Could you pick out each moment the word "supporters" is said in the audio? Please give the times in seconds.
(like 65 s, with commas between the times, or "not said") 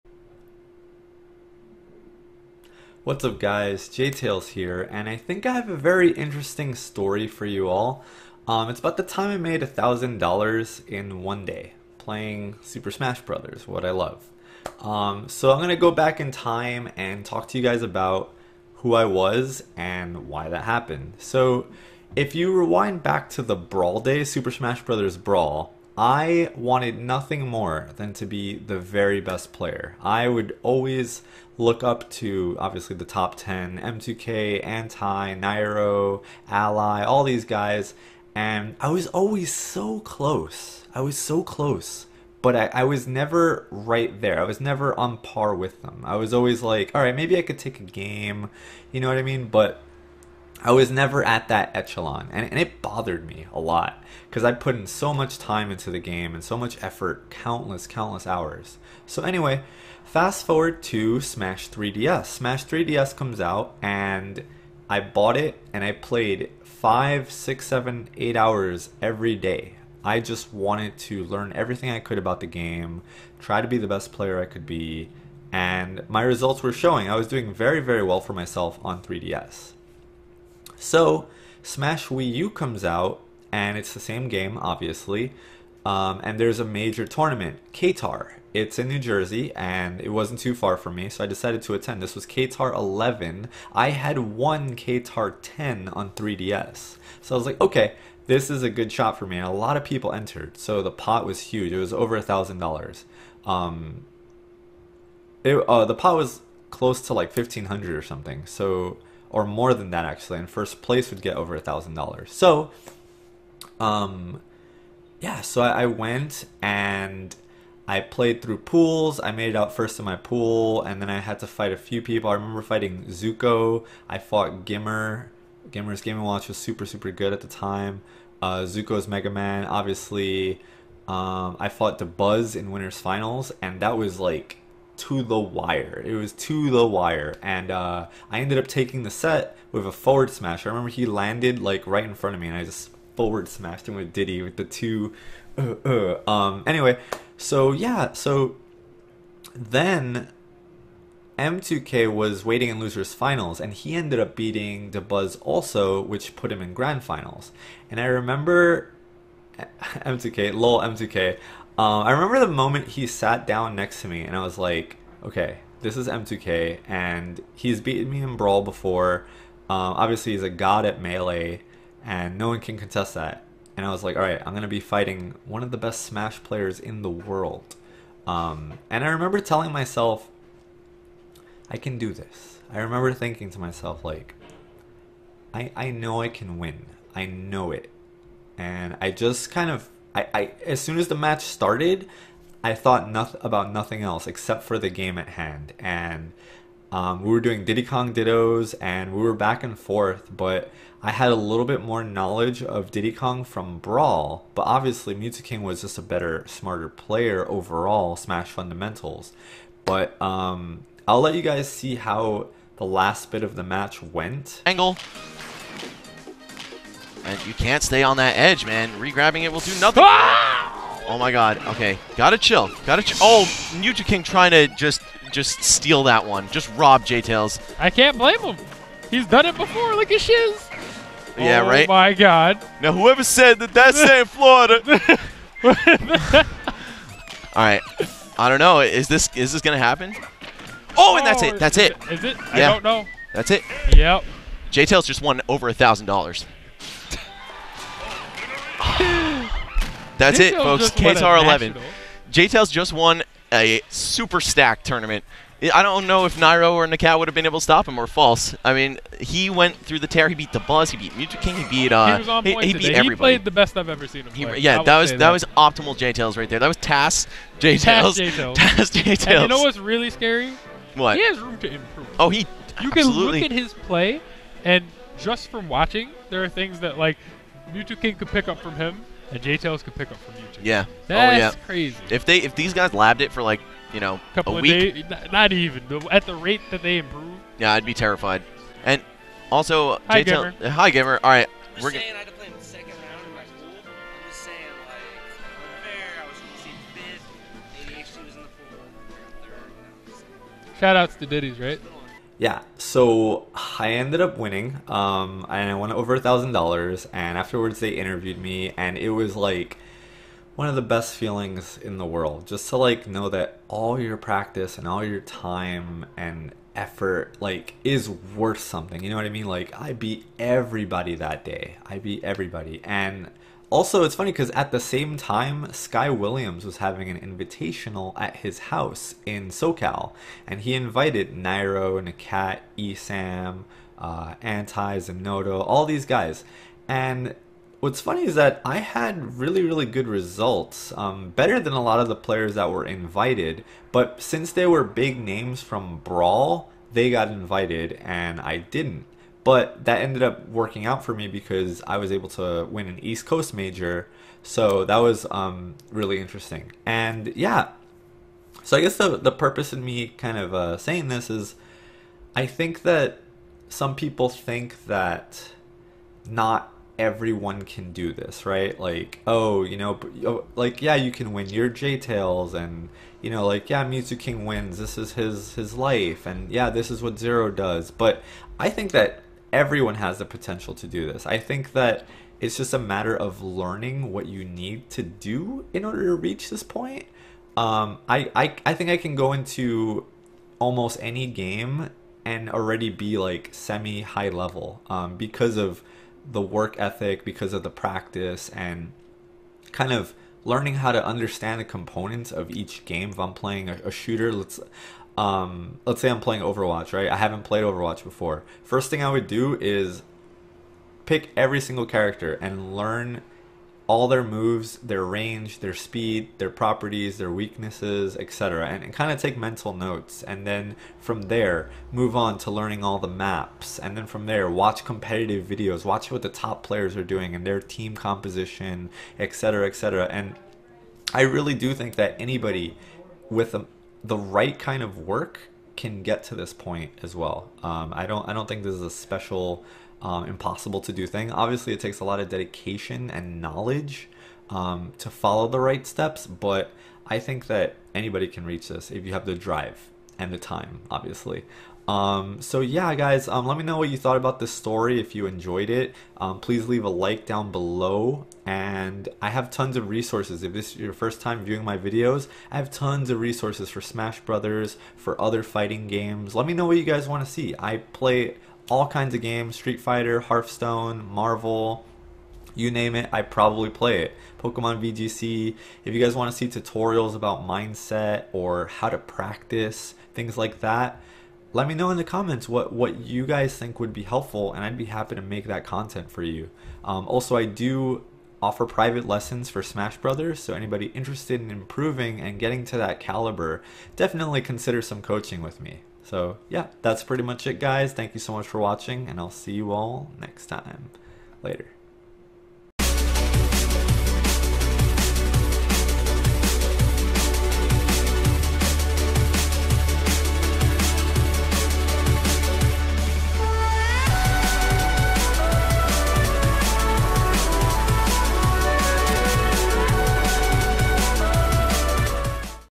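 not said.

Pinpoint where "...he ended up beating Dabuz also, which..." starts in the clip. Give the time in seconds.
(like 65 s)
153 s.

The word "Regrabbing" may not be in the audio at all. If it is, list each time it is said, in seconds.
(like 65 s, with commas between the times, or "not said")
218 s.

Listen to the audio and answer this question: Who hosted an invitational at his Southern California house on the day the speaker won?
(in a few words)
Sky Williams.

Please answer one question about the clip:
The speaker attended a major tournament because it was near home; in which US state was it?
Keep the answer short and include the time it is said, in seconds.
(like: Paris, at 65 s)
New Jersey, at 88 s.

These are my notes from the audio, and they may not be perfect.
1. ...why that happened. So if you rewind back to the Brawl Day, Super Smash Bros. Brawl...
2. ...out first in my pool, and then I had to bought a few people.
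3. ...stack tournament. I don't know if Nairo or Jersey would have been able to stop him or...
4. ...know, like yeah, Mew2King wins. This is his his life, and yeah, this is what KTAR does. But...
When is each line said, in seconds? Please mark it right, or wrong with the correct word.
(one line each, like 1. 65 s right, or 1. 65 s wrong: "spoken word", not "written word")
1. 20 s right
2. 119 s wrong: "fight", not "bought"
3. 254 s wrong: "Nakat", not "Jersey"
4. 373 s wrong: "Zero", not "KTAR".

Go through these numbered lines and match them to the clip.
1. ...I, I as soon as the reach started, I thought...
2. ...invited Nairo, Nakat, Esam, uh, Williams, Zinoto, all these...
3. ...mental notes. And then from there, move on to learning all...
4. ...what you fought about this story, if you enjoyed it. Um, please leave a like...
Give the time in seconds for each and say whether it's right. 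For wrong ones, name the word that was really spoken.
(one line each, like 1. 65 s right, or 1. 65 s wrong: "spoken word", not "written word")
1. 190 s wrong: "match", not "reach"
2. 330 s wrong: "Anti", not "Williams"
3. 419 s right
4. 453 s wrong: "thought", not "fought".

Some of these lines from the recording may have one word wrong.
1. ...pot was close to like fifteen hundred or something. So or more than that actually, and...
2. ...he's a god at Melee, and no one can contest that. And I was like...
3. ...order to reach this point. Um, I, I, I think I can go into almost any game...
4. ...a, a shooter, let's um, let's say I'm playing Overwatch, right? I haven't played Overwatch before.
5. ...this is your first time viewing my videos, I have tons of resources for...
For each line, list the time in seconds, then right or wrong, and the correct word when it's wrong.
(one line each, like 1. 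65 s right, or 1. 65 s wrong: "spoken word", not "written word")
1. 105 s right
2. 170 s right
3. 385 s right
4. 403 s right
5. 460 s right.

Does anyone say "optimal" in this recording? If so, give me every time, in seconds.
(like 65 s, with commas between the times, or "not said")
265 s.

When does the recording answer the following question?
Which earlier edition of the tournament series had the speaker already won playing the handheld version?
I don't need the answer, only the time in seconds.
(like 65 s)
94 s.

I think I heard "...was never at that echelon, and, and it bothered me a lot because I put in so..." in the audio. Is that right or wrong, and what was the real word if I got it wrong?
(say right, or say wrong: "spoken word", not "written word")
right.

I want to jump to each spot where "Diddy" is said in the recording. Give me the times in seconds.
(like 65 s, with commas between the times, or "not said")
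144 s, 197 s, 202 s, 301 s.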